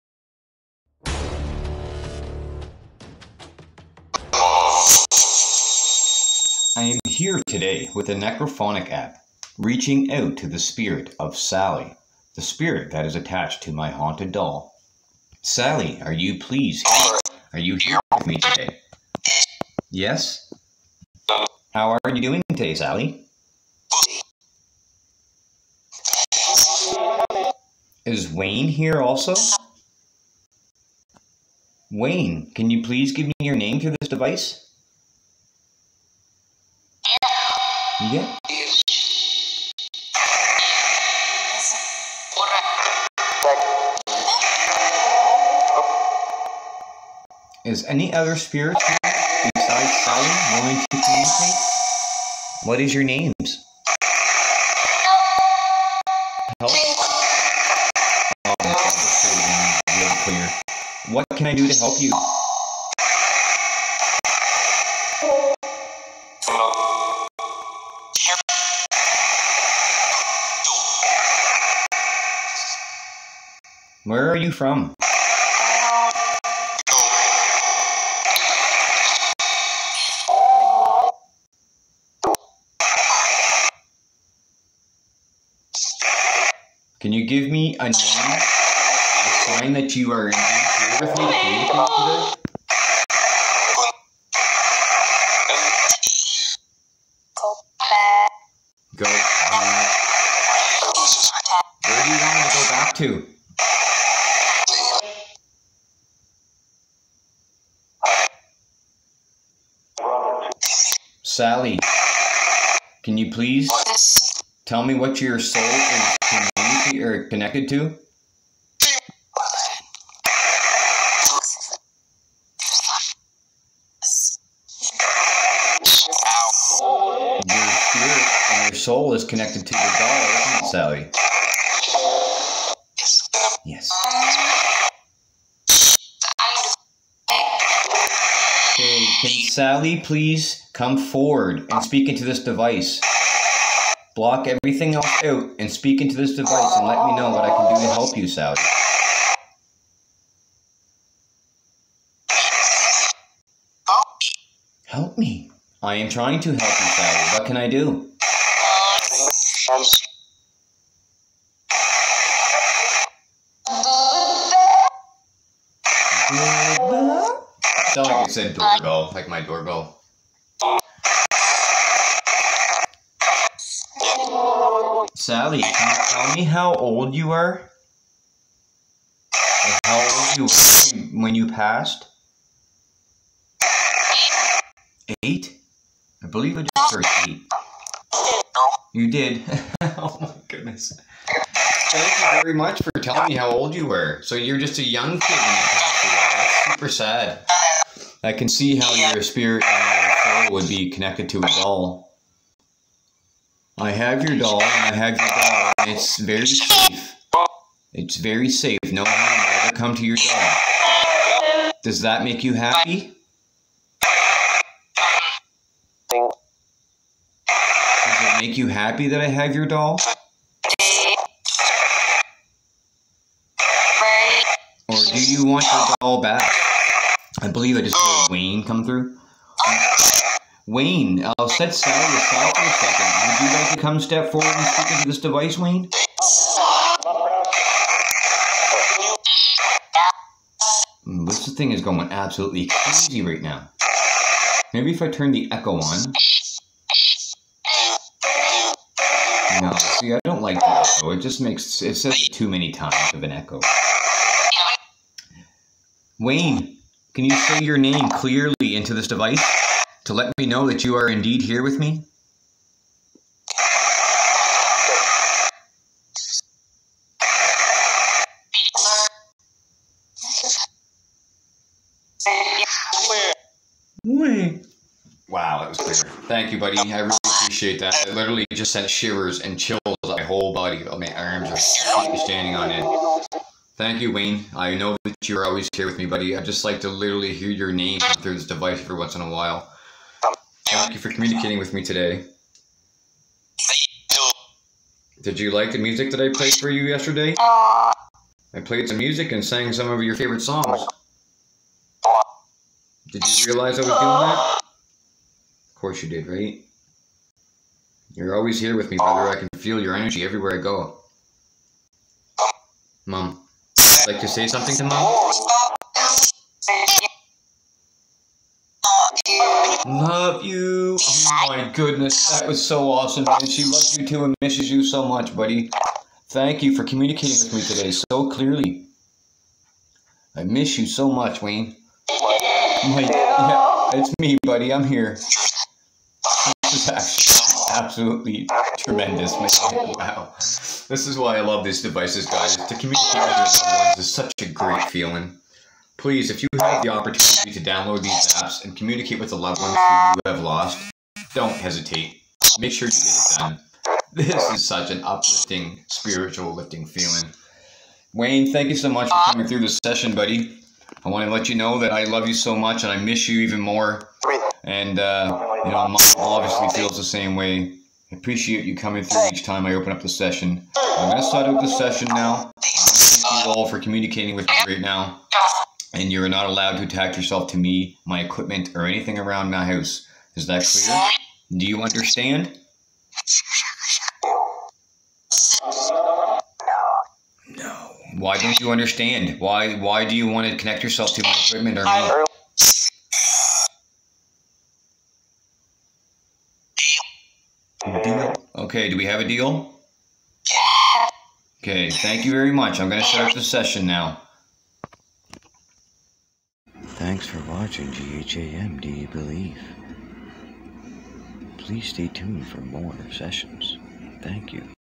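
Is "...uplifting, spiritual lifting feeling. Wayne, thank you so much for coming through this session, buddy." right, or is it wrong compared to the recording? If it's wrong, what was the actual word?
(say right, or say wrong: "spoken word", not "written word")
right.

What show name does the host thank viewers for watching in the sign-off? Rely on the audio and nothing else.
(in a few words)
GHAM Do You Believe?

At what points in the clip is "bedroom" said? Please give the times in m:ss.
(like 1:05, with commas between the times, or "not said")
not said.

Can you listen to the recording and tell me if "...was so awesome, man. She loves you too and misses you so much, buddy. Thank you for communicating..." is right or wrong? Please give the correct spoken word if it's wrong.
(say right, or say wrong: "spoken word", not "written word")
right.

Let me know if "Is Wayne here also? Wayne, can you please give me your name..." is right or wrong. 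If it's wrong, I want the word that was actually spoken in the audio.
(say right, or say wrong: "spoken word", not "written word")
right.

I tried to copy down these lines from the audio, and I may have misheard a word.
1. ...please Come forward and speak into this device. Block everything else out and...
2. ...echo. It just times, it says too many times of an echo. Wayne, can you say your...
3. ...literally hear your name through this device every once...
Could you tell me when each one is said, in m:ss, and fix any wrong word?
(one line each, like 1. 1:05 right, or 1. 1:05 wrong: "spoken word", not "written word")
1. 2:20 right
2. 4:10 wrong: "makes", not "times"
3. 4:46 right.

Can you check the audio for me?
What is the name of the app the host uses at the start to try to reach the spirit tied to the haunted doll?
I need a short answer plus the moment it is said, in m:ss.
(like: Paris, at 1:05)
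Necrophonic, at 0:08.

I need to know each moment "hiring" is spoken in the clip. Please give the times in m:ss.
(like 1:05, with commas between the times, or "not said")
not said.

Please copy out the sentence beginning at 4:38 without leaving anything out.
I literally just sent shivers and chills my whole body.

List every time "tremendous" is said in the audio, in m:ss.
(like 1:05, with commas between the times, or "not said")
5:38.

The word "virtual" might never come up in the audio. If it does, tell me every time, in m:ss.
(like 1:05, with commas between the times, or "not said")
not said.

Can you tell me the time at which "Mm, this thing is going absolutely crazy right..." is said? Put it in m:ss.
4:01.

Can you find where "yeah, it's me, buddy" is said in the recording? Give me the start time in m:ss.
5:32.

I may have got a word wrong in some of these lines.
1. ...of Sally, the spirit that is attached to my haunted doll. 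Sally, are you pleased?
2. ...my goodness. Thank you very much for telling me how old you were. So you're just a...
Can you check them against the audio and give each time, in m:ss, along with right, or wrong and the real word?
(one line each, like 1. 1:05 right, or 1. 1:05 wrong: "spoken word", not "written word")
1. 0:11 right
2. 3:10 right.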